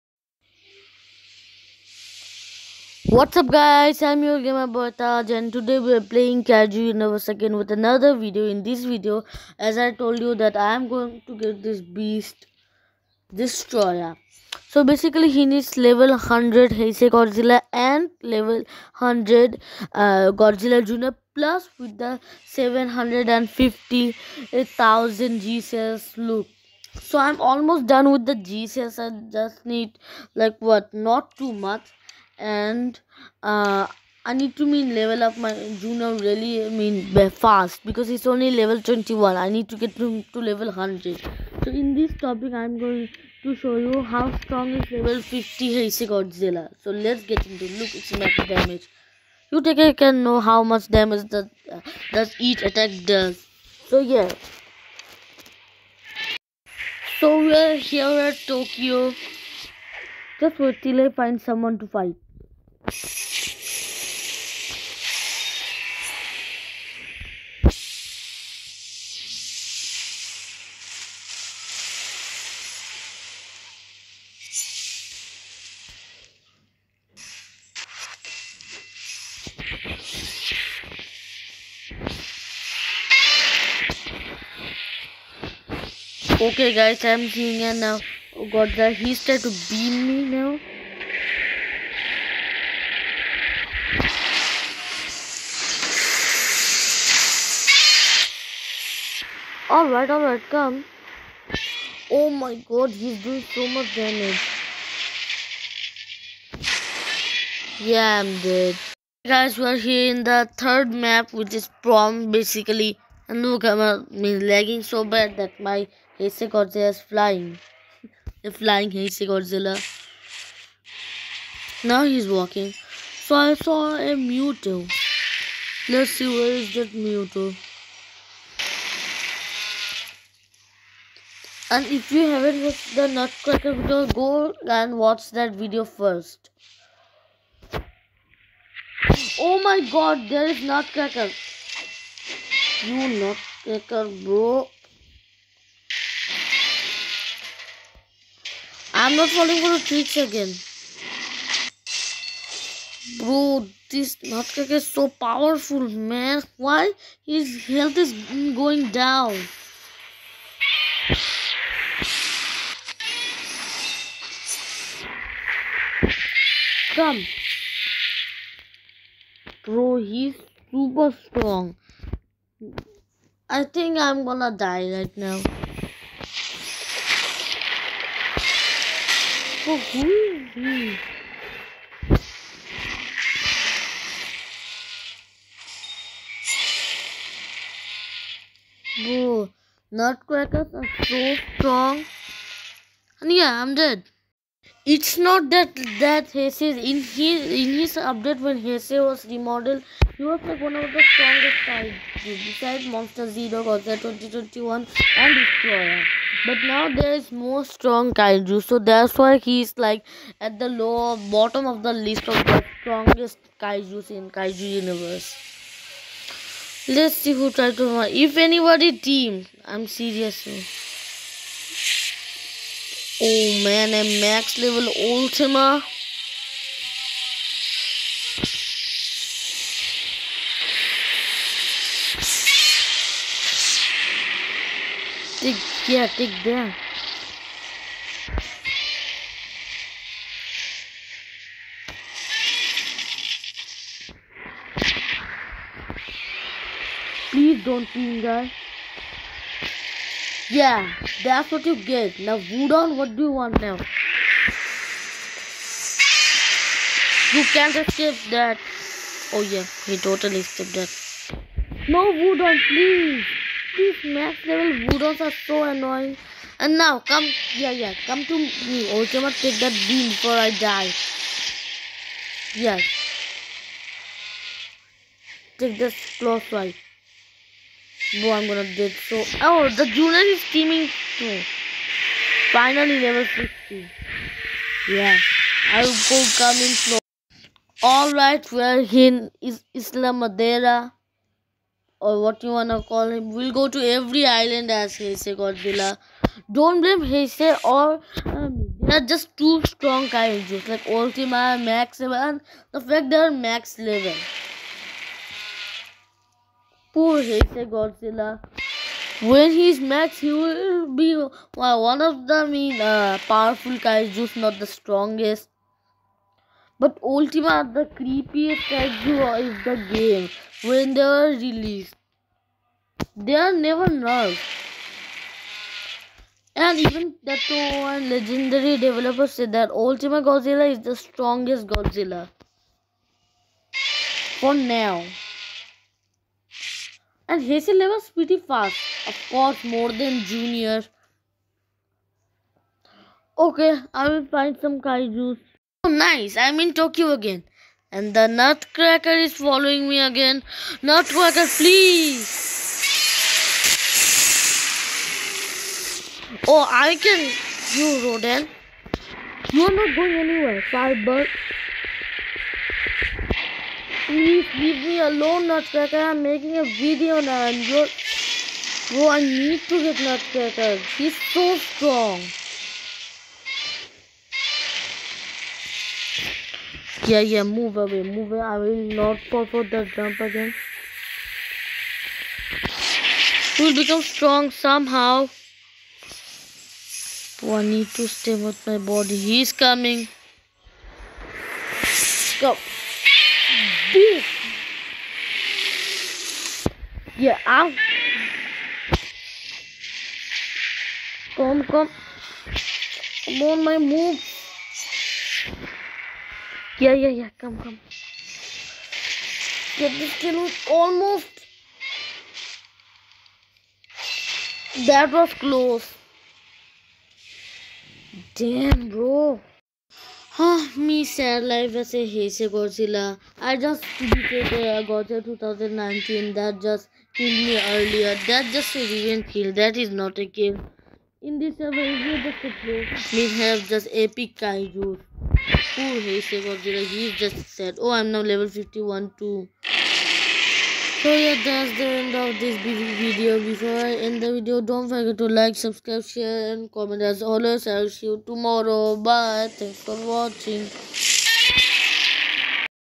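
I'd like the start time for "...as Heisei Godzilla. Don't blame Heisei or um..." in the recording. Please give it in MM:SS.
04:54.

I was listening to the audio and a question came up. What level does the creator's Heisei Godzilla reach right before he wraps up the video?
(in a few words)
51.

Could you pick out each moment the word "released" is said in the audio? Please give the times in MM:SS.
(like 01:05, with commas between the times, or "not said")
05:21.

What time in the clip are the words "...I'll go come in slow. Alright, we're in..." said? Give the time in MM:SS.
04:45.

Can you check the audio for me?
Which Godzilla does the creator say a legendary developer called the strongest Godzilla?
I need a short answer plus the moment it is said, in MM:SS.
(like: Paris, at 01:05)
Ultima Godzilla, at 05:29.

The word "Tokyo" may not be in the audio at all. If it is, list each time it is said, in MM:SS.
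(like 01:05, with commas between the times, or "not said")
00:58, 05:46.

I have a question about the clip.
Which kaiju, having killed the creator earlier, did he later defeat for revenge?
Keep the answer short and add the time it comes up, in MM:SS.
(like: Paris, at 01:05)
Godzilla 2019, at 07:04.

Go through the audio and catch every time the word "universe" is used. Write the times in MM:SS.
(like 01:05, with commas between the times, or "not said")
00:06, 03:34.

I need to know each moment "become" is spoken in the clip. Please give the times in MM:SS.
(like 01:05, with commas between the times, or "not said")
06:23.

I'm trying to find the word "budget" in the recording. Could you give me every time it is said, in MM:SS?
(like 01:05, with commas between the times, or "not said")
not said.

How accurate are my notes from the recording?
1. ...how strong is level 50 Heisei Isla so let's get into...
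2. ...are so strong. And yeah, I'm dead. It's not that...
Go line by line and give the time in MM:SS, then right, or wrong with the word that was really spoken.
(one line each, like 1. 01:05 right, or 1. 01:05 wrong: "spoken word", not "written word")
1. 00:44 wrong: "Godzilla", not "Isla"
2. 03:10 right.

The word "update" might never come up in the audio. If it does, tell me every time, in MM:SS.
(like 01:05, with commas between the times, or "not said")
03:17.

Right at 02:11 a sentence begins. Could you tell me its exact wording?
And if you haven't watched the Nutcracker video, go and watch that video first.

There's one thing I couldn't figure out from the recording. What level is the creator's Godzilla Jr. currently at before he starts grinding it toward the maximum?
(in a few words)
21.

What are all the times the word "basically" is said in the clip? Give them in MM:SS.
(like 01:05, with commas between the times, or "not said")
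00:14, 01:52.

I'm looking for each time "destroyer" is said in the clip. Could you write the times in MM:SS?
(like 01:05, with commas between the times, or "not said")
00:13, 03:25.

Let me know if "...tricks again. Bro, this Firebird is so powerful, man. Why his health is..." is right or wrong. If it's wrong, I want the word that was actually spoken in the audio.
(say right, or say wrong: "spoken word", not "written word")
wrong: "Nutcracker", not "Firebird".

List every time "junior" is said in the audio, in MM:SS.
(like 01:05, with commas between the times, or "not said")
04:39, 05:40.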